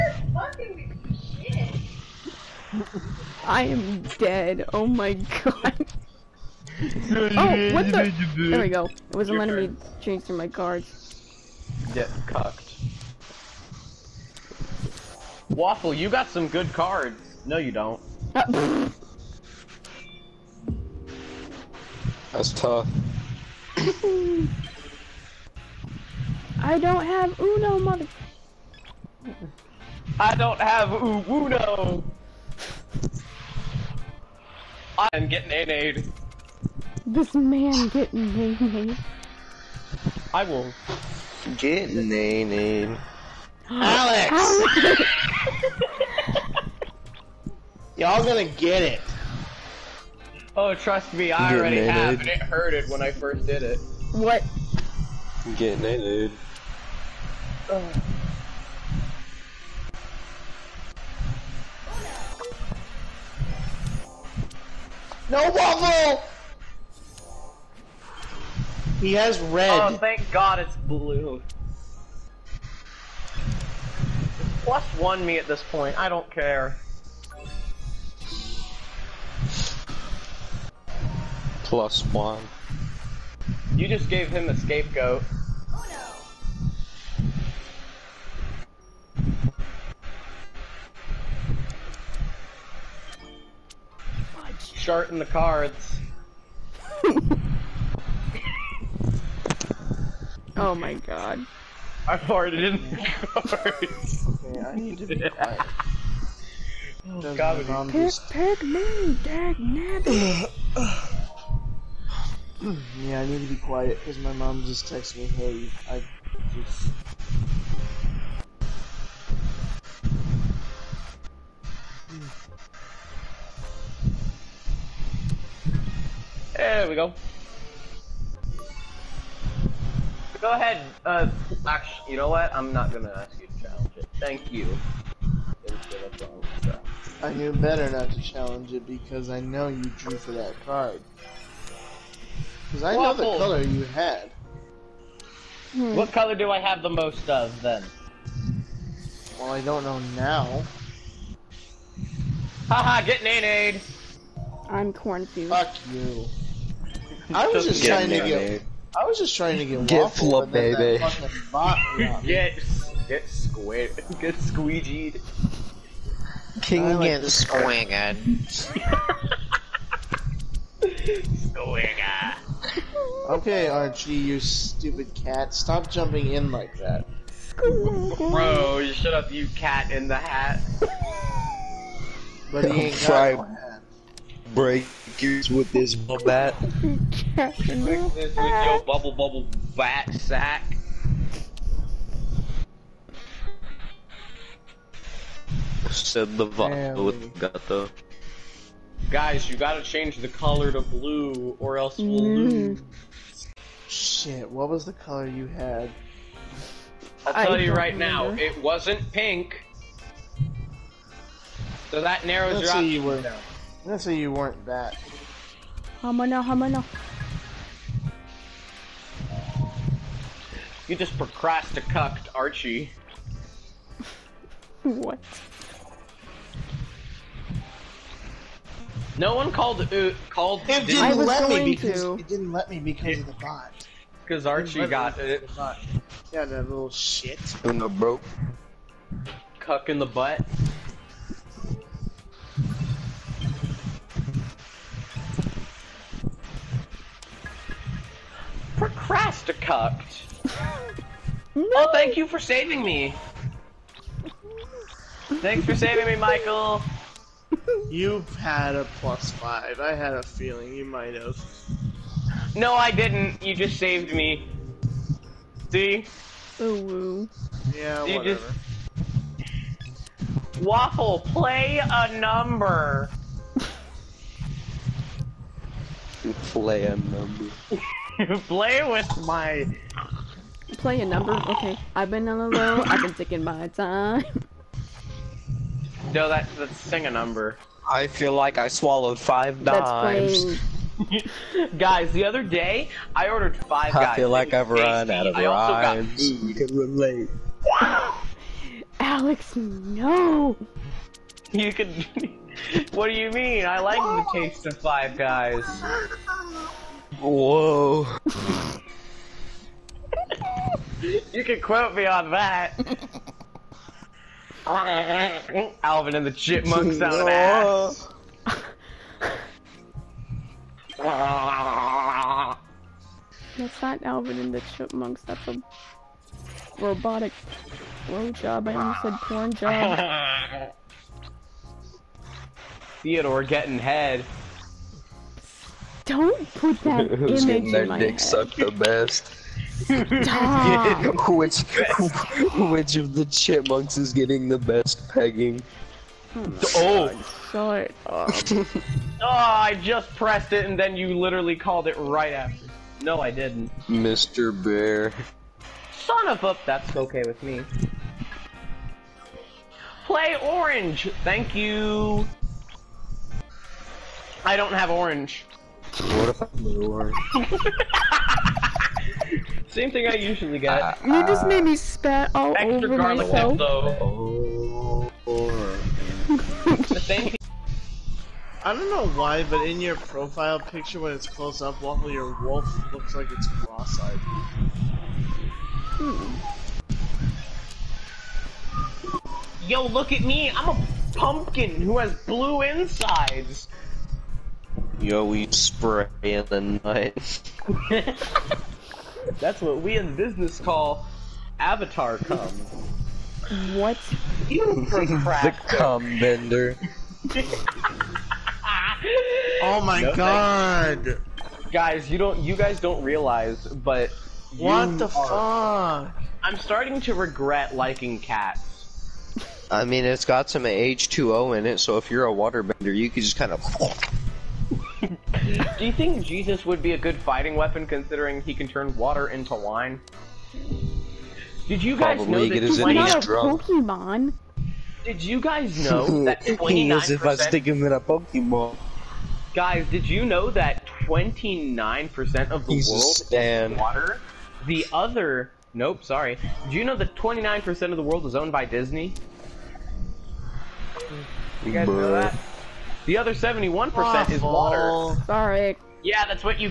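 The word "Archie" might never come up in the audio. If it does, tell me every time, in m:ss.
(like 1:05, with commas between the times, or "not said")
2:53, 3:42, 3:54.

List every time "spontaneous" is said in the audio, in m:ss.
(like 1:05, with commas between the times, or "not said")
not said.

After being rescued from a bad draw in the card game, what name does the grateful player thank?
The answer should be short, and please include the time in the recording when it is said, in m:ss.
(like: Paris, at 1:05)
Michael, at 4:16.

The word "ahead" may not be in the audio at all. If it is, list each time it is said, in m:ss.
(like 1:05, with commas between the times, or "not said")
2:10.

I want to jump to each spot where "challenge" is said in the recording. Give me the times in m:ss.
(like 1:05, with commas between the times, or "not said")
2:13, 2:18.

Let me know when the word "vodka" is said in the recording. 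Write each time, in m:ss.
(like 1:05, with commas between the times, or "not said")
3:16.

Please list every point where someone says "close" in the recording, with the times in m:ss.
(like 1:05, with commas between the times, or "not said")
6:21.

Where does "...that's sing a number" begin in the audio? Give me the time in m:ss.
4:46.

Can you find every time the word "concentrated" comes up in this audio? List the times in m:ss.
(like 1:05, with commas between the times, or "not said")
not said.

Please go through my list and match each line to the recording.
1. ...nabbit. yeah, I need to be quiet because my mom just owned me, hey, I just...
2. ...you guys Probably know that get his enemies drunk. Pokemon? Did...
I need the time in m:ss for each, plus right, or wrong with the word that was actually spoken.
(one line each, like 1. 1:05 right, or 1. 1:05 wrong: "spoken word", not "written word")
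1. 1:49 wrong: "texted", not "owned"
2. 7:11 right.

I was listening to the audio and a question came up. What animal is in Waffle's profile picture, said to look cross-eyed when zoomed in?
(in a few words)
Wolf.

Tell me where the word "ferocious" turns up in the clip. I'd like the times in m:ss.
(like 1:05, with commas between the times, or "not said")
not said.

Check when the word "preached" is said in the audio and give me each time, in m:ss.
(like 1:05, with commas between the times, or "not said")
not said.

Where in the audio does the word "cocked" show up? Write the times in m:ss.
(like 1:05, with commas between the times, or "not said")
0:12.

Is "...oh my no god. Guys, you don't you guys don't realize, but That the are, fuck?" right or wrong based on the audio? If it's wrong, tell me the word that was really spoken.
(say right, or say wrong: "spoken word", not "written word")
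wrong: "What", not "That".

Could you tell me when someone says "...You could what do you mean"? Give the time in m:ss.
5:01.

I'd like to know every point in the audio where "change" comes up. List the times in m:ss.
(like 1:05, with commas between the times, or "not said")
0:10, 3:19.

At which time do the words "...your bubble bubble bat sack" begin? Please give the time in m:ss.
3:08.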